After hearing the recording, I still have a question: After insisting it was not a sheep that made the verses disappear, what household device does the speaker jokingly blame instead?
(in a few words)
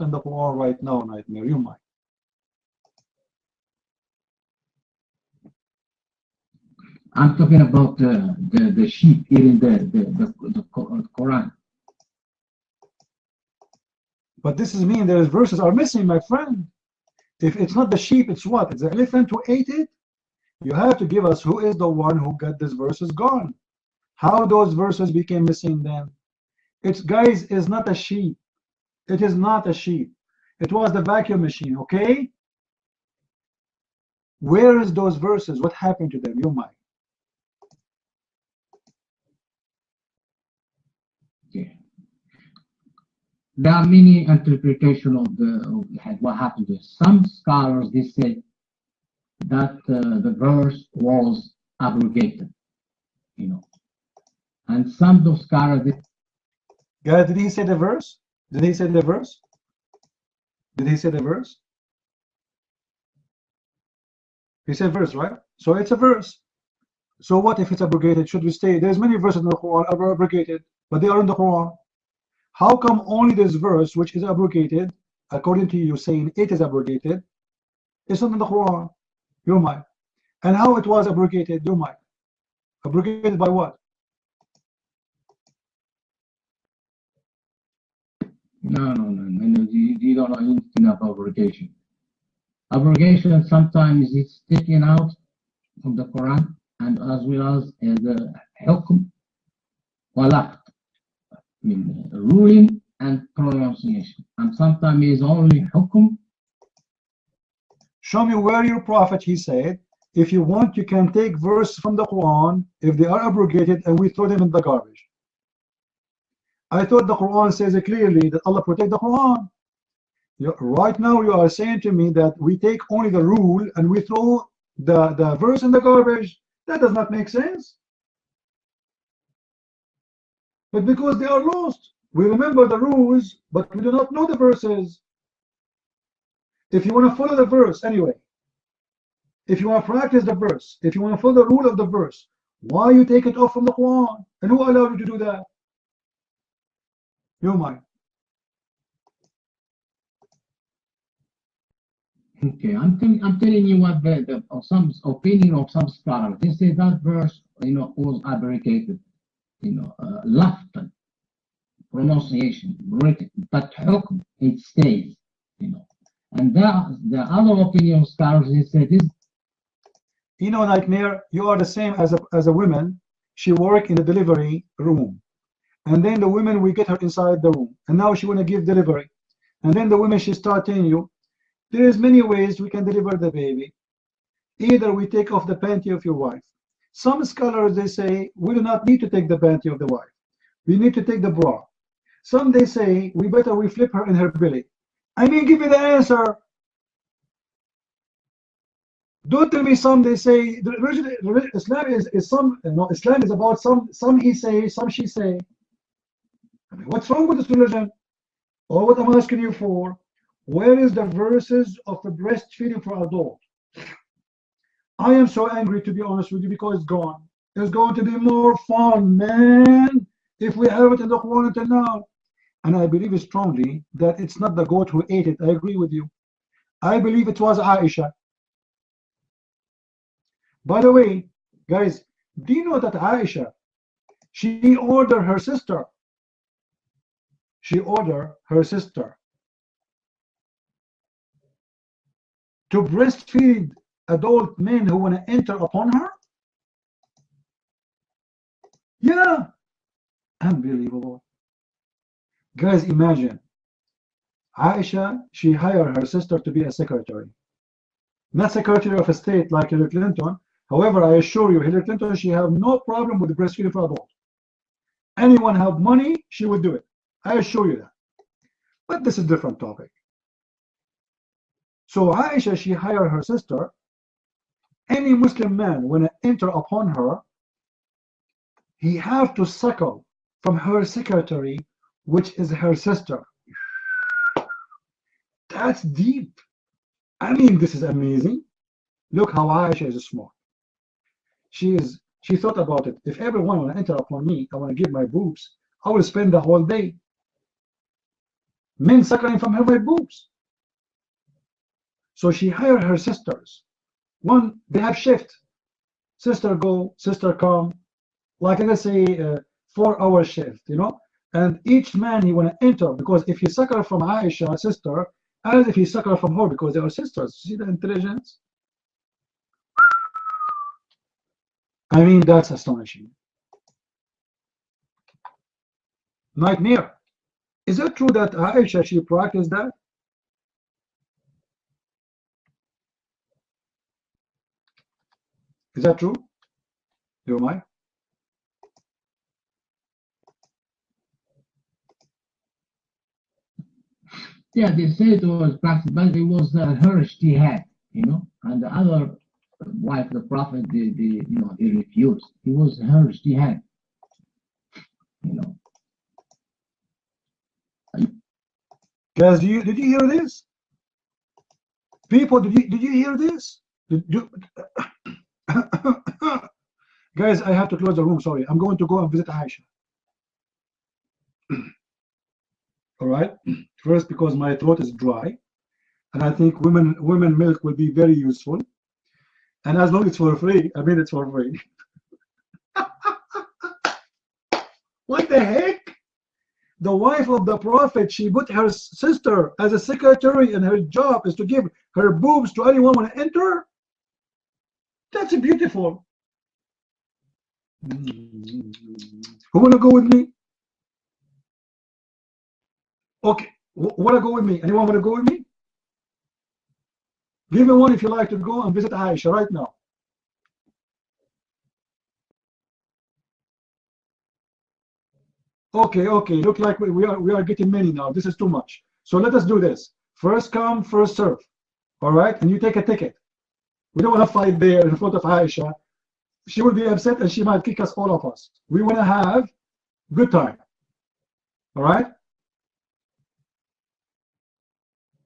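Vacuum machine.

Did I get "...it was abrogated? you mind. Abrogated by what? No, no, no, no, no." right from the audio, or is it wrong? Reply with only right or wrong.
right.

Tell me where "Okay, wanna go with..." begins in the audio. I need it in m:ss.
6:43.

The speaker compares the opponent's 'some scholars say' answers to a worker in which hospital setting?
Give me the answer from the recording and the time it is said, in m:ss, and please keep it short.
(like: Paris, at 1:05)
Delivery room, at 2:54.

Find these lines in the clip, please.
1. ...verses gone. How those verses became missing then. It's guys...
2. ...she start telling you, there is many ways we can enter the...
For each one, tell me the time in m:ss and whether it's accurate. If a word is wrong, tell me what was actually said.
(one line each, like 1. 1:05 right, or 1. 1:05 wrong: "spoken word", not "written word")
1. 0:22 right
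2. 3:00 wrong: "deliver", not "enter".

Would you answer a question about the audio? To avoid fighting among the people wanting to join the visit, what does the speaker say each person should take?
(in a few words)
A ticket.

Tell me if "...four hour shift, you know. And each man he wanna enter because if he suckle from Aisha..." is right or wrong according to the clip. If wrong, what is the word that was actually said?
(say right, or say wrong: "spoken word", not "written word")
right.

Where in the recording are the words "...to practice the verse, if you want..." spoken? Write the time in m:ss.
2:19.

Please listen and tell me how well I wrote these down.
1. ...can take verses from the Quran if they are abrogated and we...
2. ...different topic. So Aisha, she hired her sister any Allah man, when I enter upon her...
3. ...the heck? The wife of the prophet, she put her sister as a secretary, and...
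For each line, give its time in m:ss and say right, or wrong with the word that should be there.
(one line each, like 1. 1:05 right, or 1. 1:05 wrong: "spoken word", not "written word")
1. 1:50 right
2. 4:29 wrong: "Muslim", not "Allah"
3. 6:25 right.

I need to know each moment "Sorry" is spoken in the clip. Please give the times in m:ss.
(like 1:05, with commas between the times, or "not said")
6:08.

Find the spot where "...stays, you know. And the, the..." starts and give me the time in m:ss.
2:44.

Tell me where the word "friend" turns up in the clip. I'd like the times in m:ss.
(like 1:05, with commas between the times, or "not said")
0:16.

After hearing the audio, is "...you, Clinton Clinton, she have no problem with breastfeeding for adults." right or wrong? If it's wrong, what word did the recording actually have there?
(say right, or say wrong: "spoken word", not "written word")
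wrong: "Hillary", not "Clinton".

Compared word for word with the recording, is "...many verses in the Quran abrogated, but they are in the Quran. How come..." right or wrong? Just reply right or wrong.
right.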